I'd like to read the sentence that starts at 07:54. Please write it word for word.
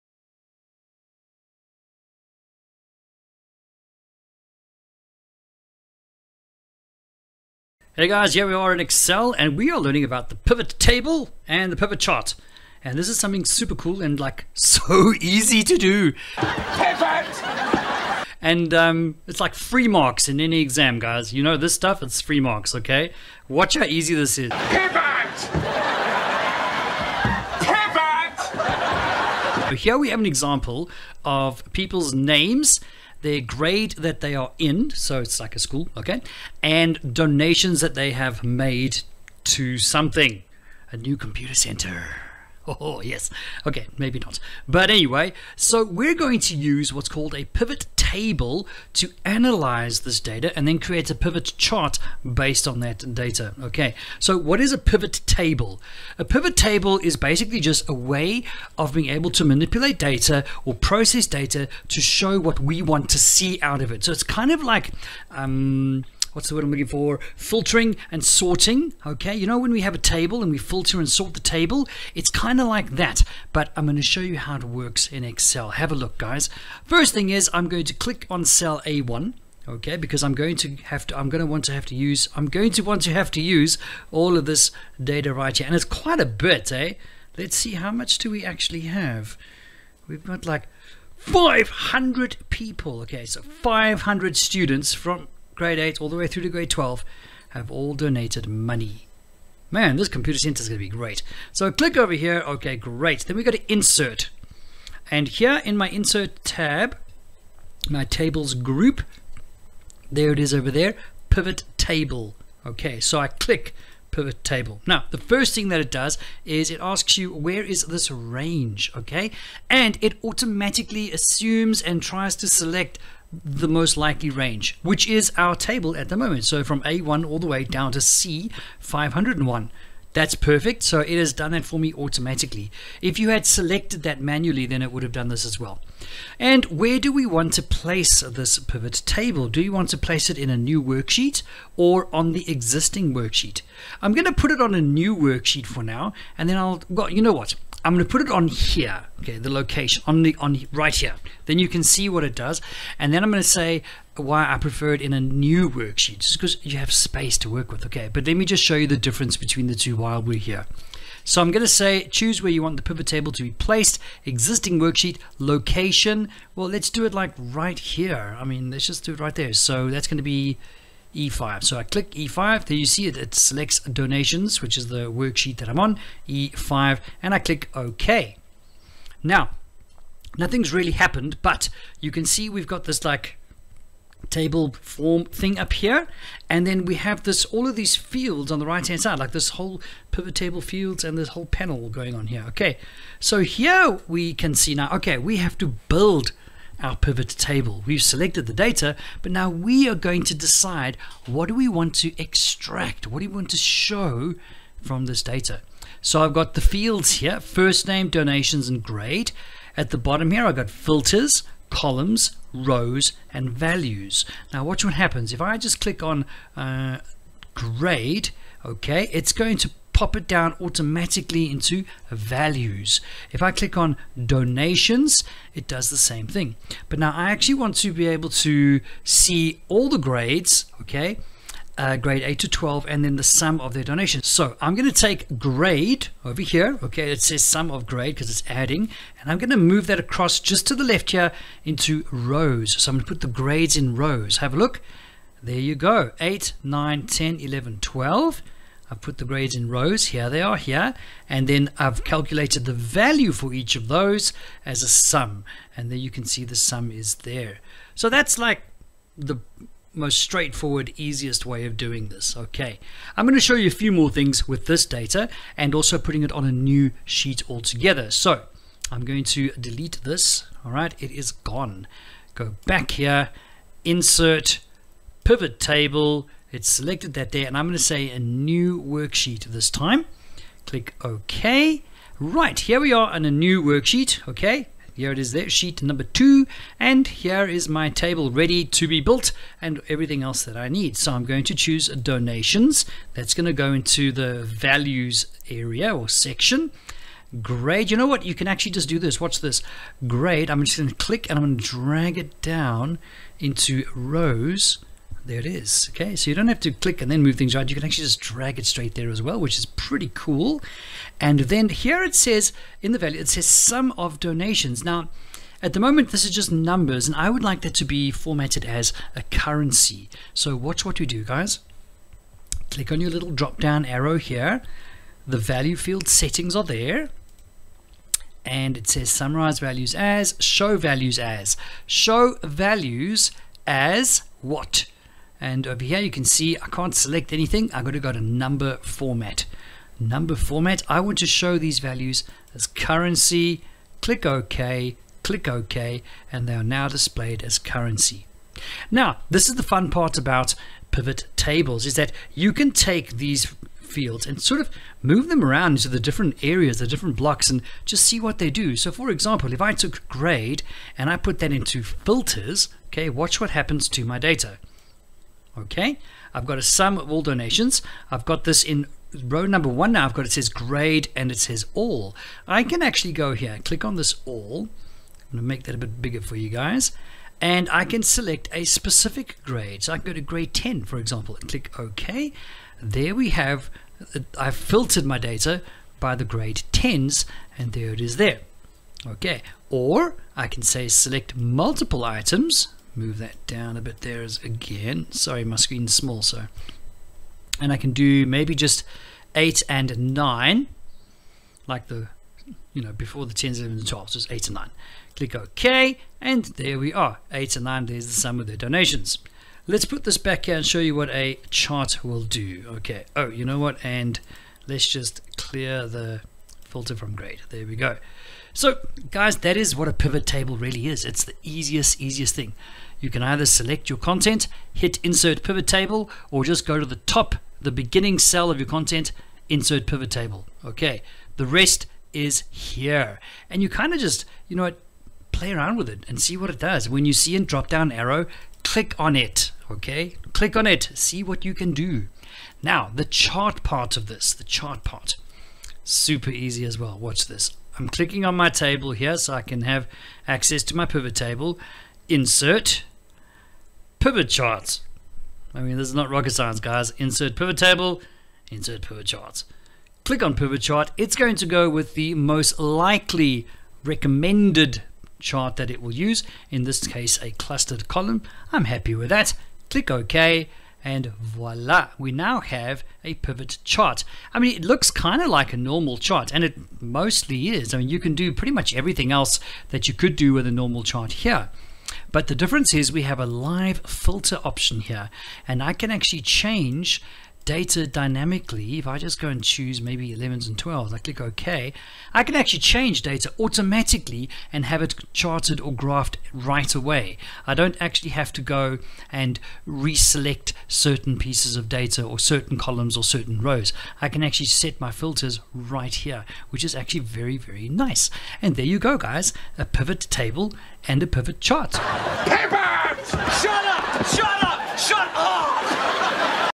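I mean, it looks kind of like a normal chart, and it mostly is.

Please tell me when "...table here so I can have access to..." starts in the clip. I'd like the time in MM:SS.
07:28.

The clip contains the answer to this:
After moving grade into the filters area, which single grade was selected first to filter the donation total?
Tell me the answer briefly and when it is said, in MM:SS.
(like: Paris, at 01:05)
Grade 10, at 06:20.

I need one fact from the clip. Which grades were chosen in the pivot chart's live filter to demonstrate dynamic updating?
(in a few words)
11 and 12.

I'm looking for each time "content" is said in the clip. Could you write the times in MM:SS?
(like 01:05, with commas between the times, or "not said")
07:03, 07:08.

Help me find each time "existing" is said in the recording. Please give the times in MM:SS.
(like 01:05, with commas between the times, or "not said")
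02:22, 02:44.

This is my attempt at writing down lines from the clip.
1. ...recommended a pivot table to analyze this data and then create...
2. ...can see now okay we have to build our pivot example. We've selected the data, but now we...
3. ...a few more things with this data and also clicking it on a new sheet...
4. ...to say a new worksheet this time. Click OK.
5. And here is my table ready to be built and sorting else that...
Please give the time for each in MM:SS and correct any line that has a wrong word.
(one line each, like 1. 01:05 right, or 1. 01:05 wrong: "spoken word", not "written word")
1. 00:47 wrong: "called", not "recommended"
2. 03:14 wrong: "table", not "example"
3. 04:23 wrong: "putting", not "clicking"
4. 04:37 right
5. 04:46 wrong: "everything", not "sorting".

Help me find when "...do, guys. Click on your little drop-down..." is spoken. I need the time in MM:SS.
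05:21.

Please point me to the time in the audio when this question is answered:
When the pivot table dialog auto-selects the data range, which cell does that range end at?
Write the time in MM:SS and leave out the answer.
02:07.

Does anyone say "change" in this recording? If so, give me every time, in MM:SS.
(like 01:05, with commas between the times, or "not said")
08:06, 08:12.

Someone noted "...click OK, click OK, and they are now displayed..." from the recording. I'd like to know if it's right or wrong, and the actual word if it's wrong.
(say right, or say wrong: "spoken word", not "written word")
right.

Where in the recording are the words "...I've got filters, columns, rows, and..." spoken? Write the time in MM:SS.
03:30.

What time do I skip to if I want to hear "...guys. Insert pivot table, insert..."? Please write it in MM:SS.
07:36.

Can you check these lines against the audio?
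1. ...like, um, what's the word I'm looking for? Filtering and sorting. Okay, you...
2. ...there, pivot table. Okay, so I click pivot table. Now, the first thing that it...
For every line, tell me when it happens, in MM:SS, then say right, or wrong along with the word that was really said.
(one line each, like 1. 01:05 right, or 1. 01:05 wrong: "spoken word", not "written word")
1. 01:04 right
2. 01:50 right.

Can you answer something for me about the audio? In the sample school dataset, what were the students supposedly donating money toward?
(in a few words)
A new computer center.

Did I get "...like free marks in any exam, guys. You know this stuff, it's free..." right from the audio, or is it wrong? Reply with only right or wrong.
right.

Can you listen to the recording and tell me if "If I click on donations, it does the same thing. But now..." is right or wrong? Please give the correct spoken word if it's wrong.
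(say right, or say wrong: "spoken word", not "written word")
right.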